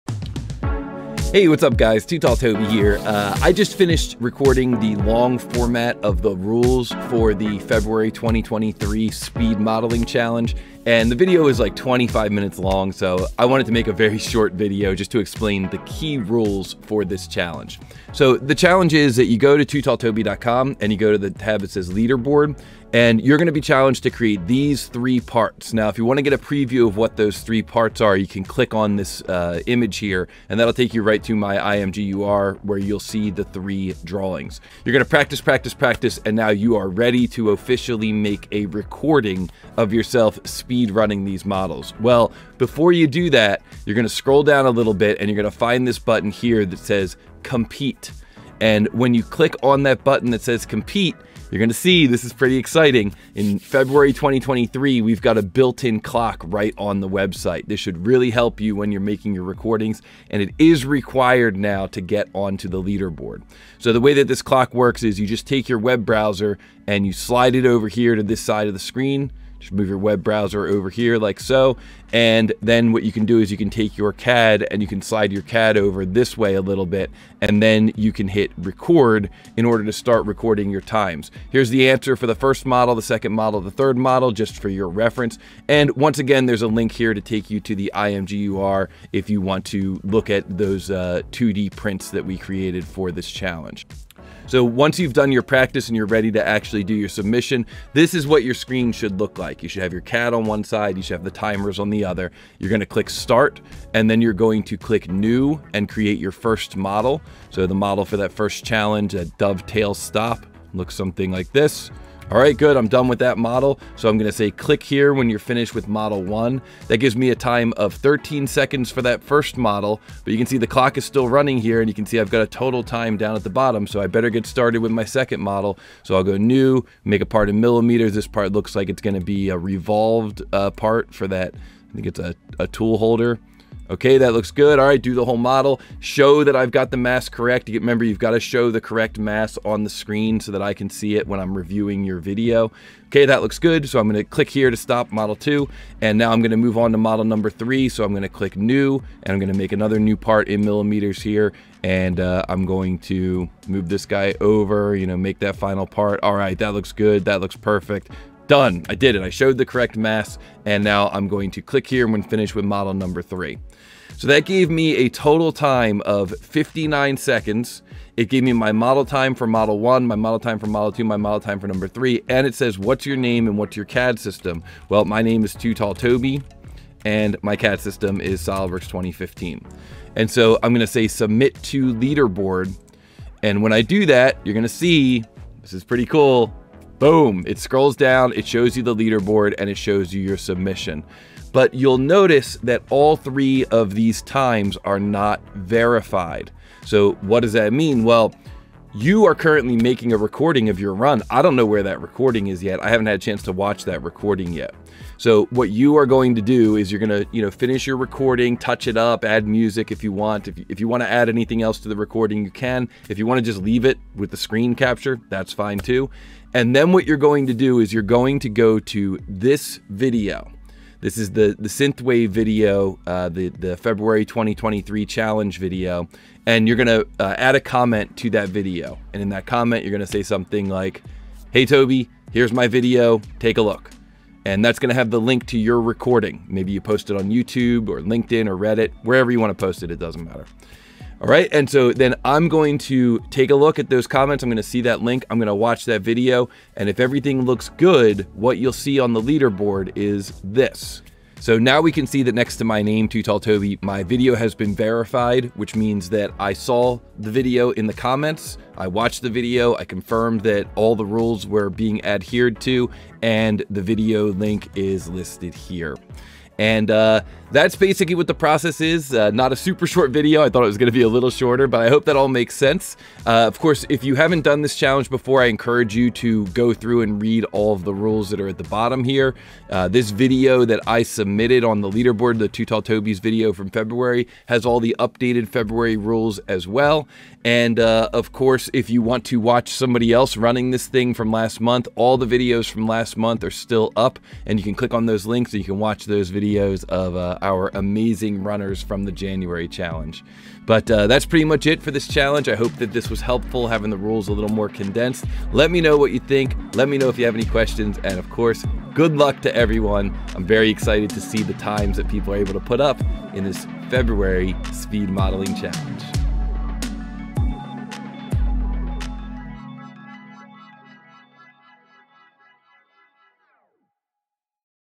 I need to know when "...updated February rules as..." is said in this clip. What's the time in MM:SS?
04:44.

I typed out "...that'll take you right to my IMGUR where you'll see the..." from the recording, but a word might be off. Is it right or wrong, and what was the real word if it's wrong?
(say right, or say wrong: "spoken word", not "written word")
right.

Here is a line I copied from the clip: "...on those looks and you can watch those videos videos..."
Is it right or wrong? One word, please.
wrong.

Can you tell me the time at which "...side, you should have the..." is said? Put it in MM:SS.
01:40.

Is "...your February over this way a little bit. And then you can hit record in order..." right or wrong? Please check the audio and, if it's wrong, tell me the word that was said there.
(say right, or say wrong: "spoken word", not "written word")
wrong: "CAD", not "February".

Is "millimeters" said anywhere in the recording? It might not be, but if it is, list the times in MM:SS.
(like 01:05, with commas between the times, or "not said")
02:07, 02:30.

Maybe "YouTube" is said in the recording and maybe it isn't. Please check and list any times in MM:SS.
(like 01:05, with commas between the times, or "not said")
03:57.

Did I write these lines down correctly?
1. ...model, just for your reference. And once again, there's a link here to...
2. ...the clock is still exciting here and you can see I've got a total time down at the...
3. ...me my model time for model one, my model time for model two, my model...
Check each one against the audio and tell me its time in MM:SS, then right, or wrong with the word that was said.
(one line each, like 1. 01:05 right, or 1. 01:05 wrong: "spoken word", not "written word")
1. 01:23 right
2. 02:00 wrong: "running", not "exciting"
3. 02:48 right.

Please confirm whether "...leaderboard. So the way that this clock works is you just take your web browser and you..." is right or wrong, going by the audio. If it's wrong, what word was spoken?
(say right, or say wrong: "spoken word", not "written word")
right.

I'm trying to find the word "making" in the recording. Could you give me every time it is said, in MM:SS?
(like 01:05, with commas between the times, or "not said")
00:59, 03:19.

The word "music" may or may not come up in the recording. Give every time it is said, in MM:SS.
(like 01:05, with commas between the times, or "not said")
03:29.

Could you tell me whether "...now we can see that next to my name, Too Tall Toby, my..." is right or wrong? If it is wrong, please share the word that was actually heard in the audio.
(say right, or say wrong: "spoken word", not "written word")
right.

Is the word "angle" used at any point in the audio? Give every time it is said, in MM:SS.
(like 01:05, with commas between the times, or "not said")
not said.